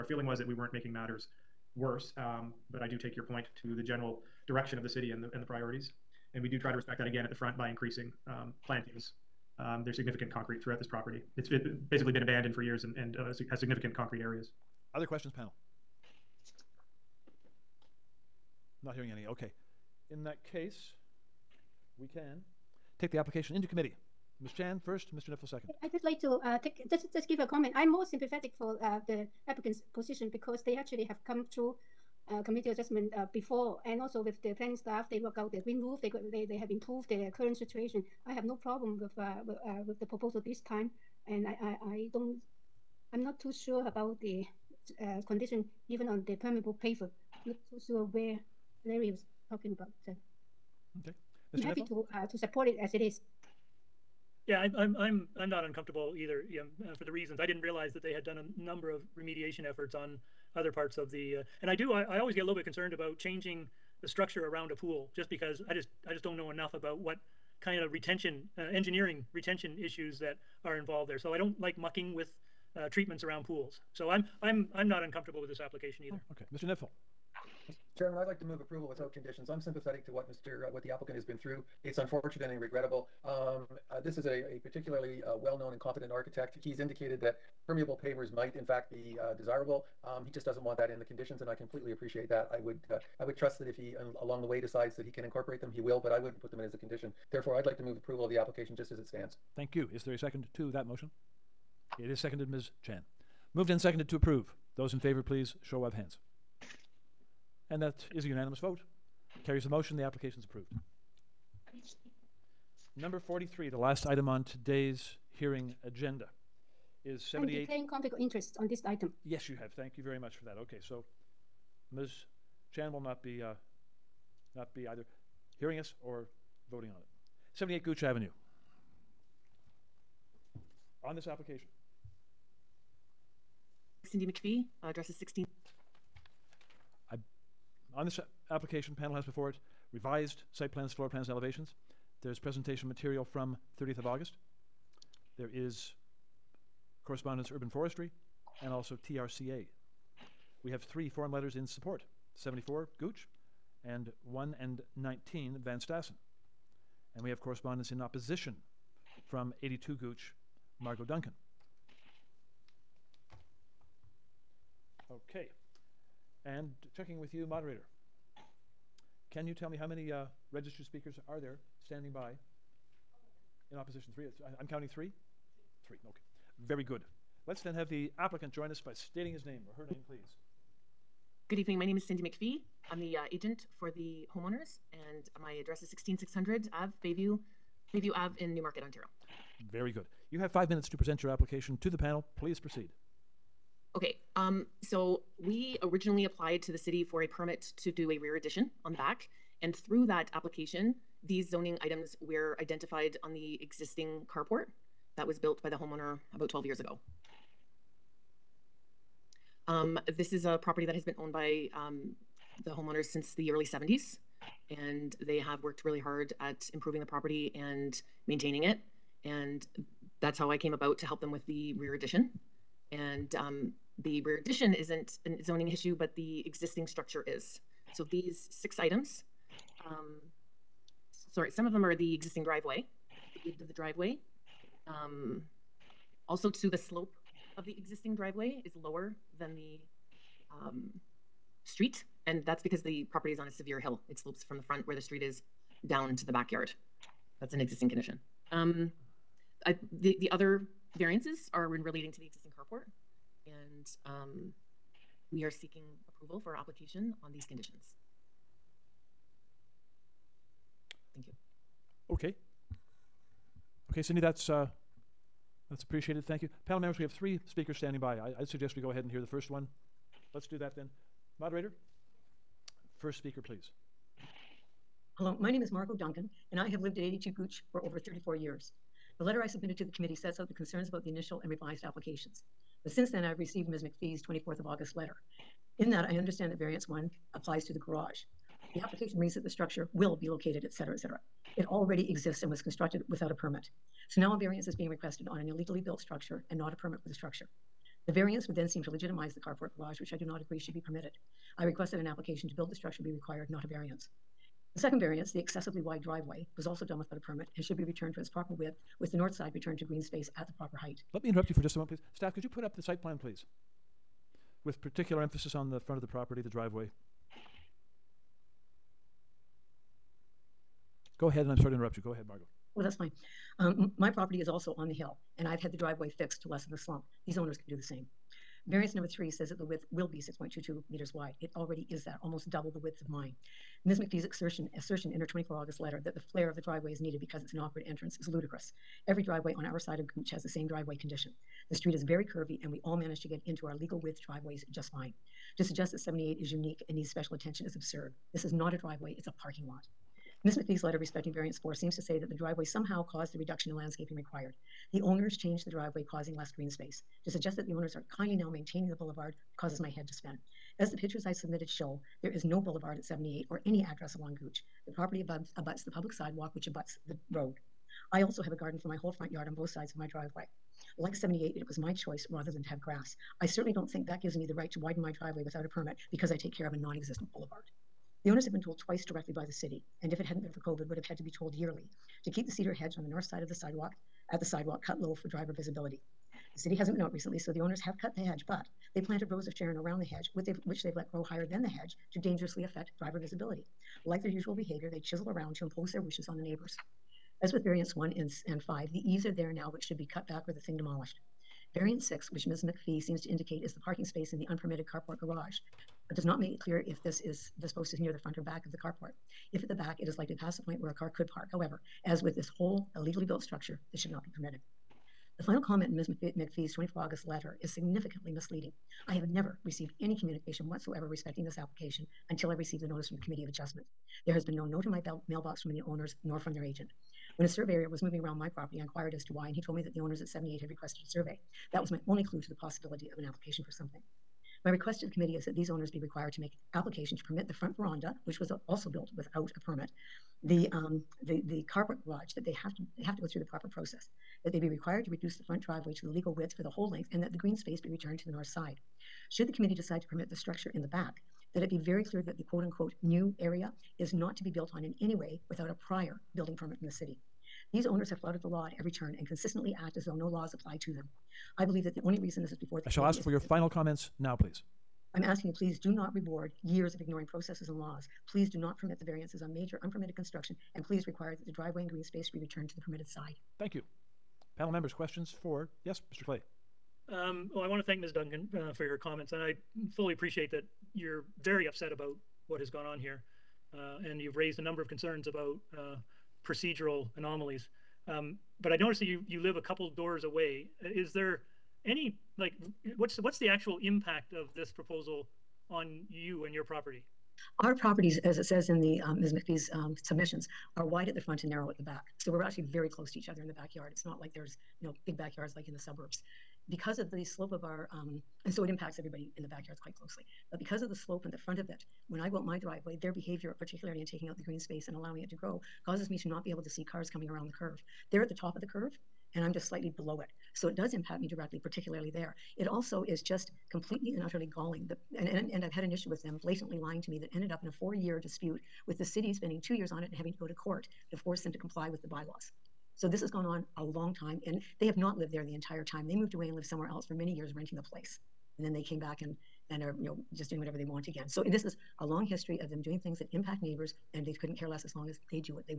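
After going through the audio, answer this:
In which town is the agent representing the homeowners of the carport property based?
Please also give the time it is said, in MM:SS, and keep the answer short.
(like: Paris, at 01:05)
Newmarket, at 03:08.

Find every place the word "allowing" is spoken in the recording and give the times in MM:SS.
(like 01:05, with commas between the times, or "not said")
08:34.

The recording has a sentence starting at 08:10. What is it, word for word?
Uh, is there any, like, what's what's the actual impact of this proposal?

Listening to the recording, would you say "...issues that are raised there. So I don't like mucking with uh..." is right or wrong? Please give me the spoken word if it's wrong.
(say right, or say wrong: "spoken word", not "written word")
wrong: "involved", not "raised".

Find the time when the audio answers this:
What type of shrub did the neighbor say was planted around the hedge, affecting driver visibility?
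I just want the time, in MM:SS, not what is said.
06:29.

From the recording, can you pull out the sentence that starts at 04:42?
But since then, I've received Ms.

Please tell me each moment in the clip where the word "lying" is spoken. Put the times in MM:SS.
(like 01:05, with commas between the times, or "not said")
08:46.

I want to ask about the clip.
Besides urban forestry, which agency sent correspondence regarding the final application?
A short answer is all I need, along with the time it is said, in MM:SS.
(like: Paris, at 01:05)
TRCA, at 02:29.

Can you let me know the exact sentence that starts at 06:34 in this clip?
Like their usual behavior, they chisel around to impose their wishes on the neighbors.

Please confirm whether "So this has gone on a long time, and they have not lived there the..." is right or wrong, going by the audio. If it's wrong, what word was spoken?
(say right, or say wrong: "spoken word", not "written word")
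right.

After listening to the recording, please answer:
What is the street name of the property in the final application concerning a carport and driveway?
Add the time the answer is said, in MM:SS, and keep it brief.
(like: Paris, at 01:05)
Gooch Avenue, at 02:07.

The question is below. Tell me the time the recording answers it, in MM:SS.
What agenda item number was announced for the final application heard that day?
01:52.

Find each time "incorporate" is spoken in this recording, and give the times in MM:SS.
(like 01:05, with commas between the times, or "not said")
01:35.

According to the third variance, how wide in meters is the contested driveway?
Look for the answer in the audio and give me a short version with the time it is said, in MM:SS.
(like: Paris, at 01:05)
6.22, at 05:30.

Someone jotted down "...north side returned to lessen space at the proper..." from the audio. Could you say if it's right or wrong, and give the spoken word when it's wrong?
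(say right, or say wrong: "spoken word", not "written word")
wrong: "green", not "lessen".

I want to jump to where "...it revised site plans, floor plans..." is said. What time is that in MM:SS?
02:19.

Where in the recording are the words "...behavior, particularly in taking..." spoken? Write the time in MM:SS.
08:33.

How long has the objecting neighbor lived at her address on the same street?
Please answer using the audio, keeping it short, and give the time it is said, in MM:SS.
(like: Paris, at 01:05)
over 34 years, at 04:37.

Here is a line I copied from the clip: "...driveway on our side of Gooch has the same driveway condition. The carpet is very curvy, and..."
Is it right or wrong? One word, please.
wrong.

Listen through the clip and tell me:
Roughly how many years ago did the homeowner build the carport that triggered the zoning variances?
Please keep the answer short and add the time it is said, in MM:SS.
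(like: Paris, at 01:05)
12, at 03:26.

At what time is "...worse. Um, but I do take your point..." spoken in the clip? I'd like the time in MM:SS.
00:01.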